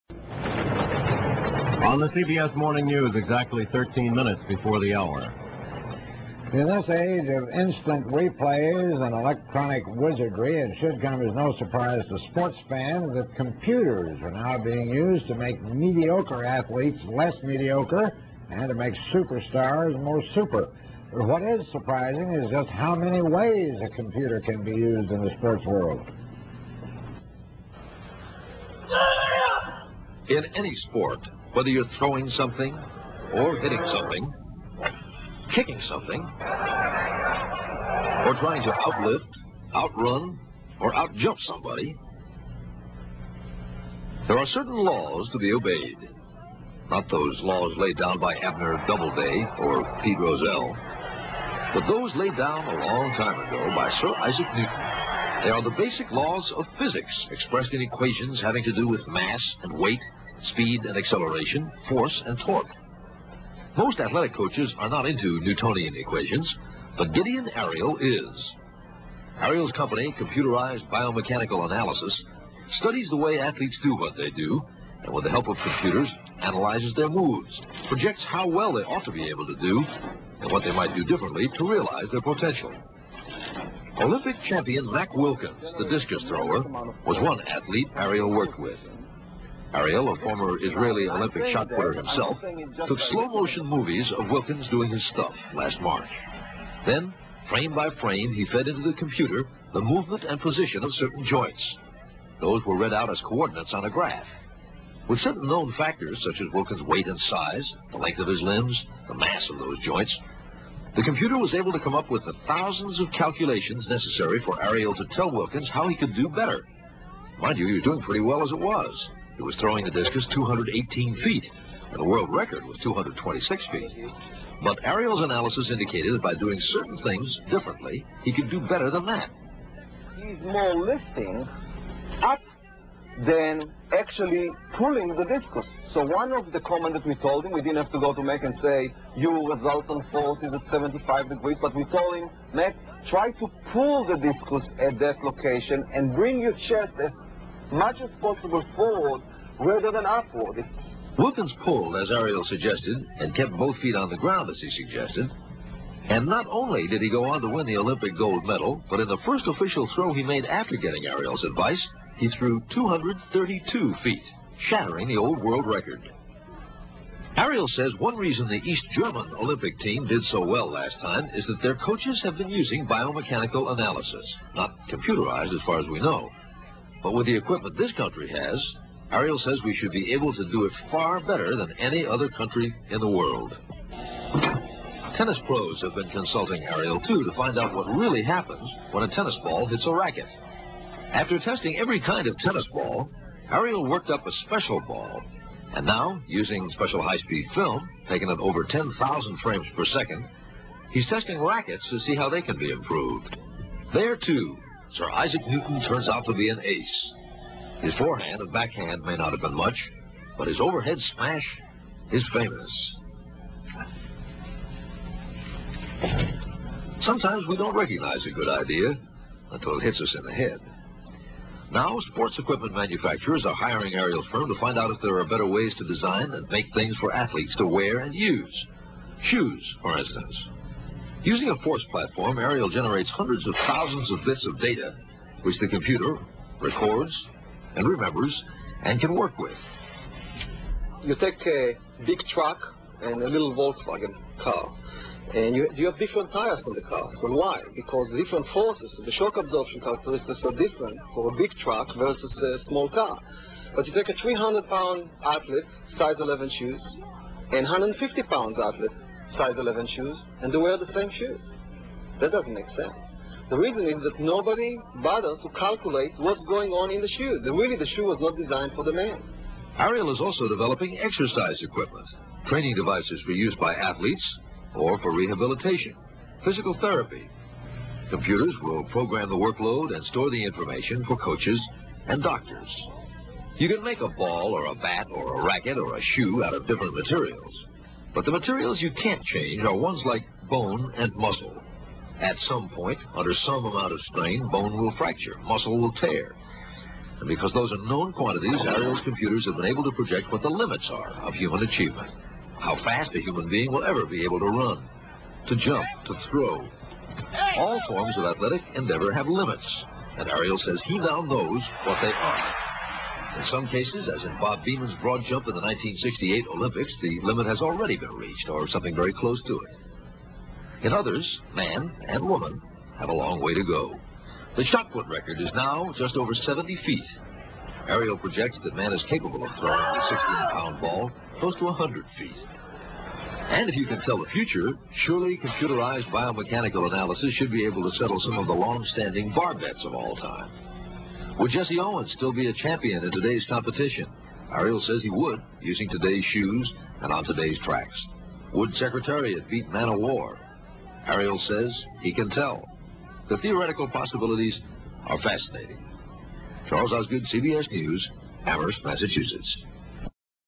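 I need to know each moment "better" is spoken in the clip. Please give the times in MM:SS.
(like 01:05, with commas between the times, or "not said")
01:56, 02:08, 03:01, 03:45.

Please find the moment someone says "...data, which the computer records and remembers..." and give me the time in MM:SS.
03:54.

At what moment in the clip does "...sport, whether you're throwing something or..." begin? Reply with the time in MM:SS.
00:30.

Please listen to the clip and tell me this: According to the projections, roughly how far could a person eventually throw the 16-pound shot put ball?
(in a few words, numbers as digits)
100 feet.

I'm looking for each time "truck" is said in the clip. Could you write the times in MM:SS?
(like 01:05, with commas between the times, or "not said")
04:02, 04:11.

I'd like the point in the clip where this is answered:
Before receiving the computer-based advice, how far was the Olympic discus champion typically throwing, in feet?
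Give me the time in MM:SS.
02:00.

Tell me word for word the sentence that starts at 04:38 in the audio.
Computers will program the workload and store the information for coaches and doctors.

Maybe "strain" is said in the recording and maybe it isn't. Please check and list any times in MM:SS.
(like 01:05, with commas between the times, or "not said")
04:54.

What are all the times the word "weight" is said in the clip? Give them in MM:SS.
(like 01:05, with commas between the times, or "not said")
00:59, 01:46.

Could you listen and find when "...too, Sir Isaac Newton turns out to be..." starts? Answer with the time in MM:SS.
03:24.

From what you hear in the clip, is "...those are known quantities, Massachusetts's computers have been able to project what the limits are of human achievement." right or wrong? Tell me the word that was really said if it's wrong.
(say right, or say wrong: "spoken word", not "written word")
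wrong: "Ariel", not "Massachusetts".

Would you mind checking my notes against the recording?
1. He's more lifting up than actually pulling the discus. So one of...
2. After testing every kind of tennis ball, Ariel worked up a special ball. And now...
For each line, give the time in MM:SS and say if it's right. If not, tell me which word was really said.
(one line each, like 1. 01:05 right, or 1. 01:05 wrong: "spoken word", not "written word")
1. 02:10 right
2. 03:11 right.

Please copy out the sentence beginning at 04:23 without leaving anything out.
The reason is that nobody bothered to calculate what's going on in the shoe.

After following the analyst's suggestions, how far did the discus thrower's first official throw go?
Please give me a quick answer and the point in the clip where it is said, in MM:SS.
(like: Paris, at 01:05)
232 feet, at 02:42.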